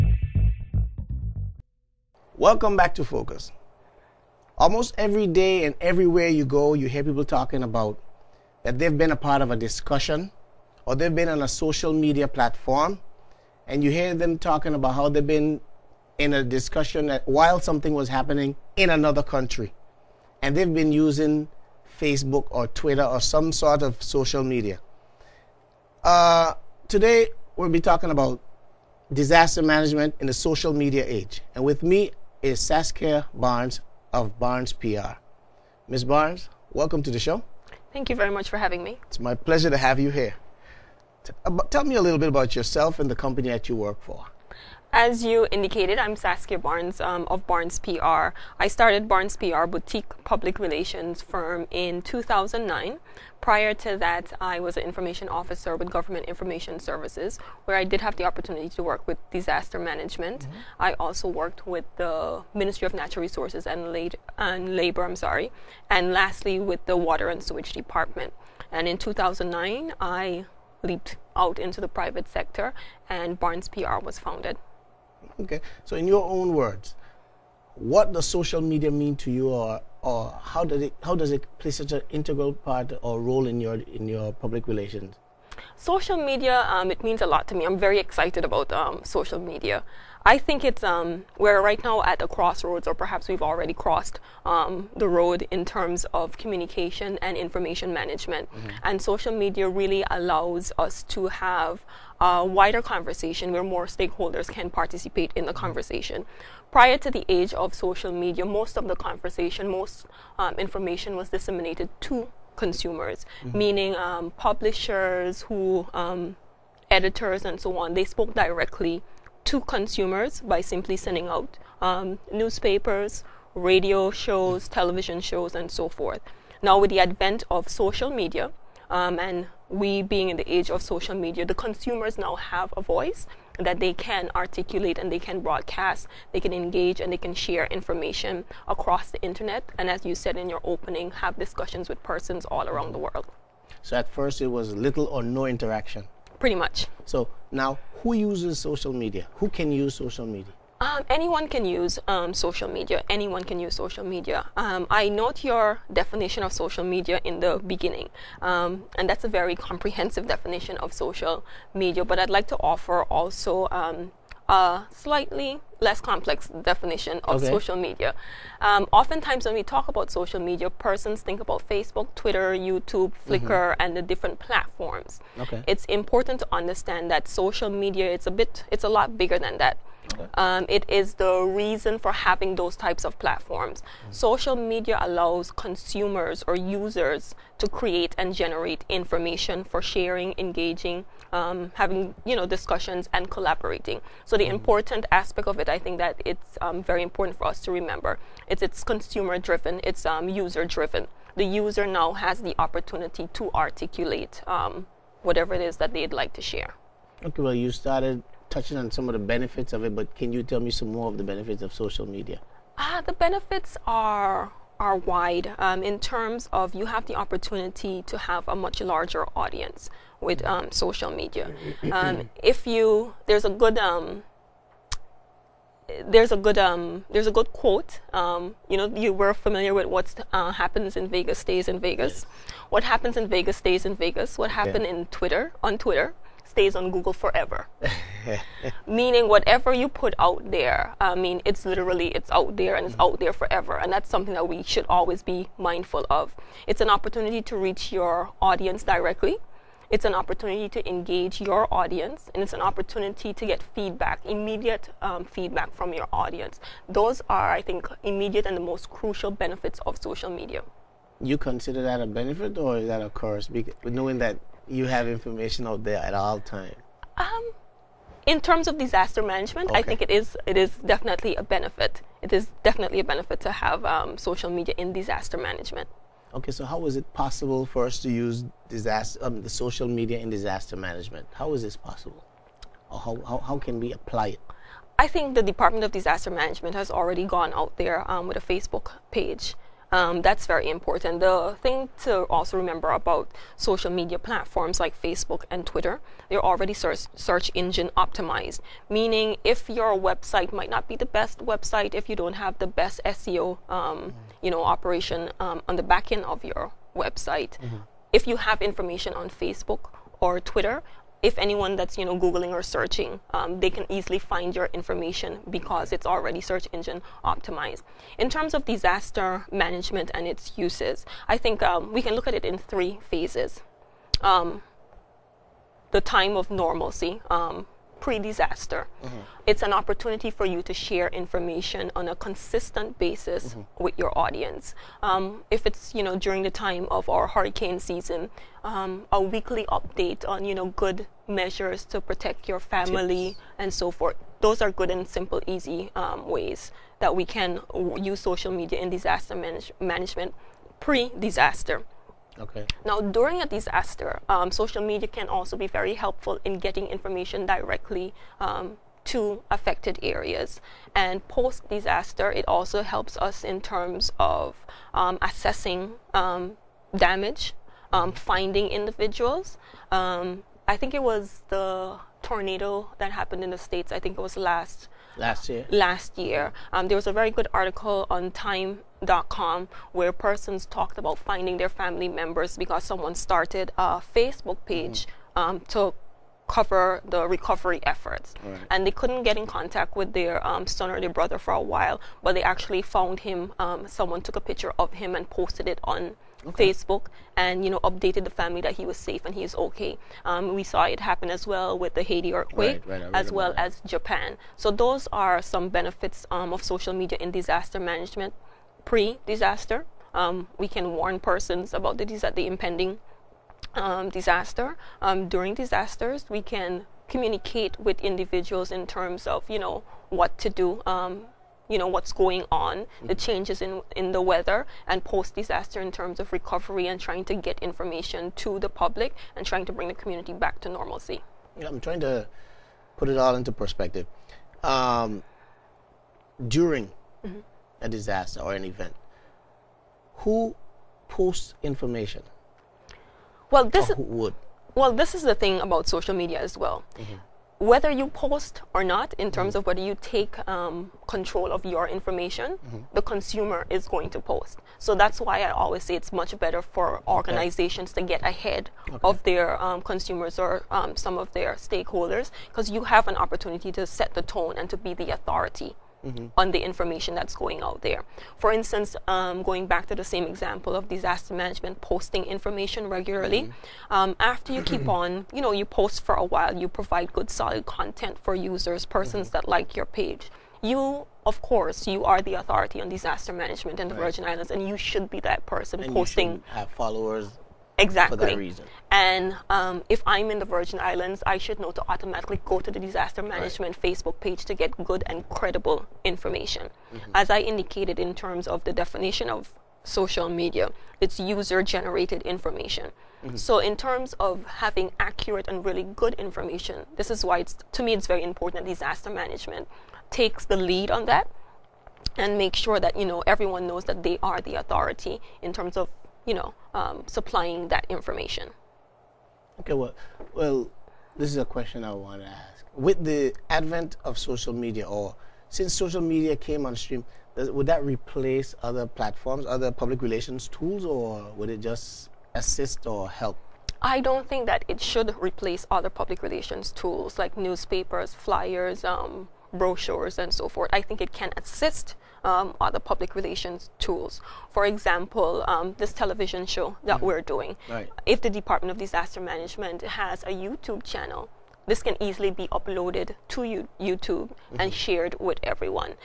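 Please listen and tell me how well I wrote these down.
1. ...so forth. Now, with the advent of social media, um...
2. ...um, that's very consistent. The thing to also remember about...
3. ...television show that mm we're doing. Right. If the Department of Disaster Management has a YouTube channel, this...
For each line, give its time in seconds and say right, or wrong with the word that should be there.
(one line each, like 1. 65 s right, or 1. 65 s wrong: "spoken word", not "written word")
1. 125 s right
2. 289 s wrong: "important", not "consistent"
3. 545 s right.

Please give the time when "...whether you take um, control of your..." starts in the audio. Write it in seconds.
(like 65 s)
449 s.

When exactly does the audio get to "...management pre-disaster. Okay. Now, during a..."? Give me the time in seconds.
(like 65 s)
349 s.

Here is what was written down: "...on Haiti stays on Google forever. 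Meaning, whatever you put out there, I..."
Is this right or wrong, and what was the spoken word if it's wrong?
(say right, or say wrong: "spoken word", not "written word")
wrong: "Twitter", not "Haiti".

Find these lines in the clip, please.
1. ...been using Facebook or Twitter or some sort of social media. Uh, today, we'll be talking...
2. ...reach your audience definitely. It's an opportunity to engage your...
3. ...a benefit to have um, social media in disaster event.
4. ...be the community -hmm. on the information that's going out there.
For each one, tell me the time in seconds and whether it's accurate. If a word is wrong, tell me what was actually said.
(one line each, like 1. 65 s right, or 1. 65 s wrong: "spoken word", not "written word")
1. 20 s right
2. 247 s wrong: "directly", not "definitely"
3. 272 s wrong: "management", not "event"
4. 464 s wrong: "authority", not "community".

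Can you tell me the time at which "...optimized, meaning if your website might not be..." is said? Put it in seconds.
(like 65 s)
297 s.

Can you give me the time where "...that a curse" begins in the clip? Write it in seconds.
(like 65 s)
262 s.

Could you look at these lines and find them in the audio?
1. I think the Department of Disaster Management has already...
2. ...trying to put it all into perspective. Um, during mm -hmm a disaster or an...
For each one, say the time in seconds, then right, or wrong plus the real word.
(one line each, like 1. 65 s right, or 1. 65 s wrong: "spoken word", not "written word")
1. 284 s right
2. 431 s right.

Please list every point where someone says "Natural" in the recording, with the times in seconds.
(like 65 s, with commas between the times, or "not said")
62 s.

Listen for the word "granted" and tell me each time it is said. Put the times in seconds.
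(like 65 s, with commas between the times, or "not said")
not said.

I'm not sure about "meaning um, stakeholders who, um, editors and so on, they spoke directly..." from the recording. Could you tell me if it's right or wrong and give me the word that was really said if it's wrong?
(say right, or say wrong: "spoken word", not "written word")
wrong: "publishers", not "stakeholders".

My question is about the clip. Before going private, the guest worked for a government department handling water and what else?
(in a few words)
Sewage.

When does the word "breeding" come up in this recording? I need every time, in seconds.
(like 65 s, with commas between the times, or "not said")
not said.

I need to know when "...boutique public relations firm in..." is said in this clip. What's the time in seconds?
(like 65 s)
49 s.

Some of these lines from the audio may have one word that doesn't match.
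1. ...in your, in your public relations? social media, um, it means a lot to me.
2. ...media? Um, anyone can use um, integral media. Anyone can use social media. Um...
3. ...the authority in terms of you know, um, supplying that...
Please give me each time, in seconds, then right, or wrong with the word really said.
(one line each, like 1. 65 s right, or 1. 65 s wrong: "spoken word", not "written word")
1. 83 s right
2. 150 s wrong: "social", not "integral"
3. 514 s right.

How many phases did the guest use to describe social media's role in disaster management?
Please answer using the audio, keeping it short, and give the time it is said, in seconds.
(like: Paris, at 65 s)
3, at 322 s.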